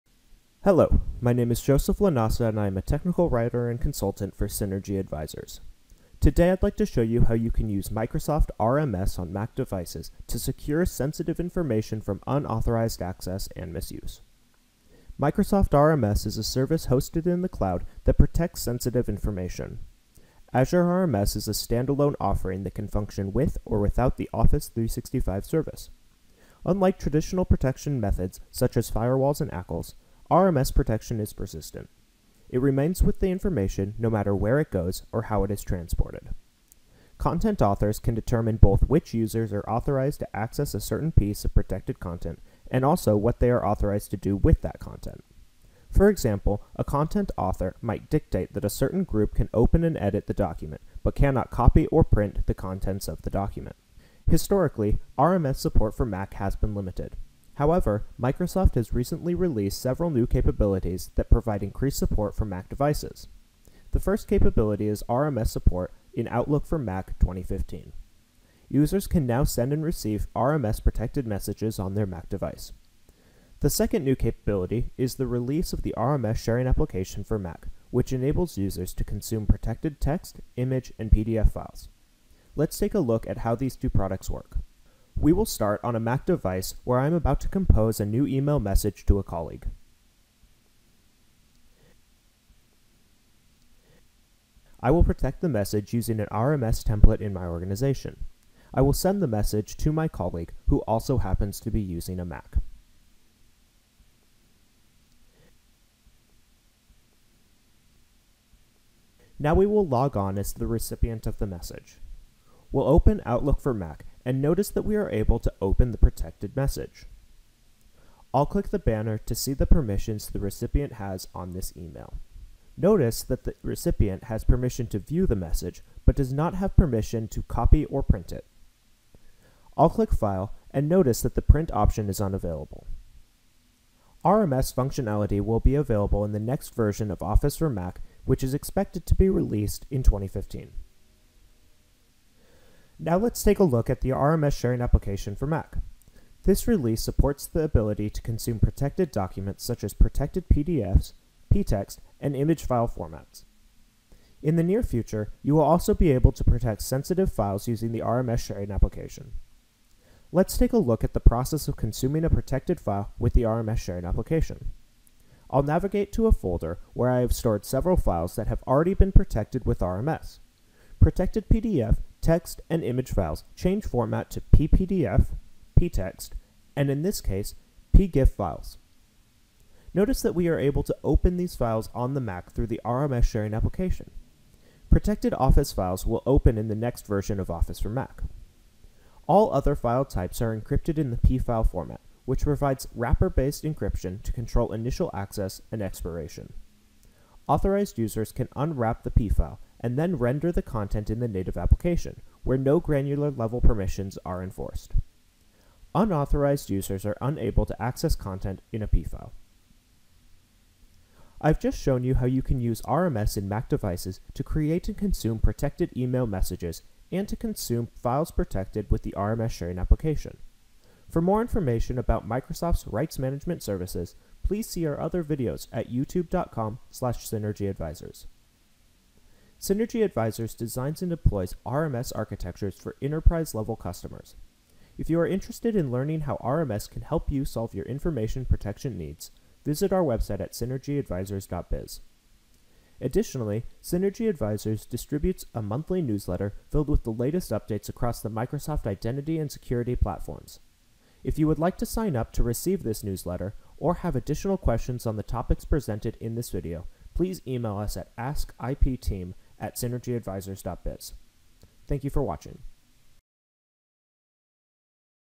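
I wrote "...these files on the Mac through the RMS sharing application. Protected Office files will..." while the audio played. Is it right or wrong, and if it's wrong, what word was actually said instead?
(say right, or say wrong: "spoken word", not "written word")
right.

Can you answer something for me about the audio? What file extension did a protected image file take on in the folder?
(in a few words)
pgif.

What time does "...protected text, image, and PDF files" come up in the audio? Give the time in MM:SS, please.
01:19.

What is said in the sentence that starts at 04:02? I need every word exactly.
Additionally, Synergy Advisors distributes a monthly newsletter filled with the latest updates across the Microsoft identity and security platforms.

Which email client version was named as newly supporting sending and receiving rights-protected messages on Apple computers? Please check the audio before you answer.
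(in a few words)
Outlook for Mac 2015.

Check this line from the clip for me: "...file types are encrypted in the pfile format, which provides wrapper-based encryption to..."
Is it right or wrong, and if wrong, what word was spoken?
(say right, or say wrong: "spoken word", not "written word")
right.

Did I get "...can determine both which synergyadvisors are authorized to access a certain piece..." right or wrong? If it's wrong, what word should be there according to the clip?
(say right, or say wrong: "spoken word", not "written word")
wrong: "users", not "synergyadvisors".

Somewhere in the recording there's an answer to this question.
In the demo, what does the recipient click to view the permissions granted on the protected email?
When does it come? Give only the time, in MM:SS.
01:58.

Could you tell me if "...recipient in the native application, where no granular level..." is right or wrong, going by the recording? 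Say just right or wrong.
wrong.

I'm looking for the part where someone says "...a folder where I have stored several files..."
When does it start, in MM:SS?
02:46.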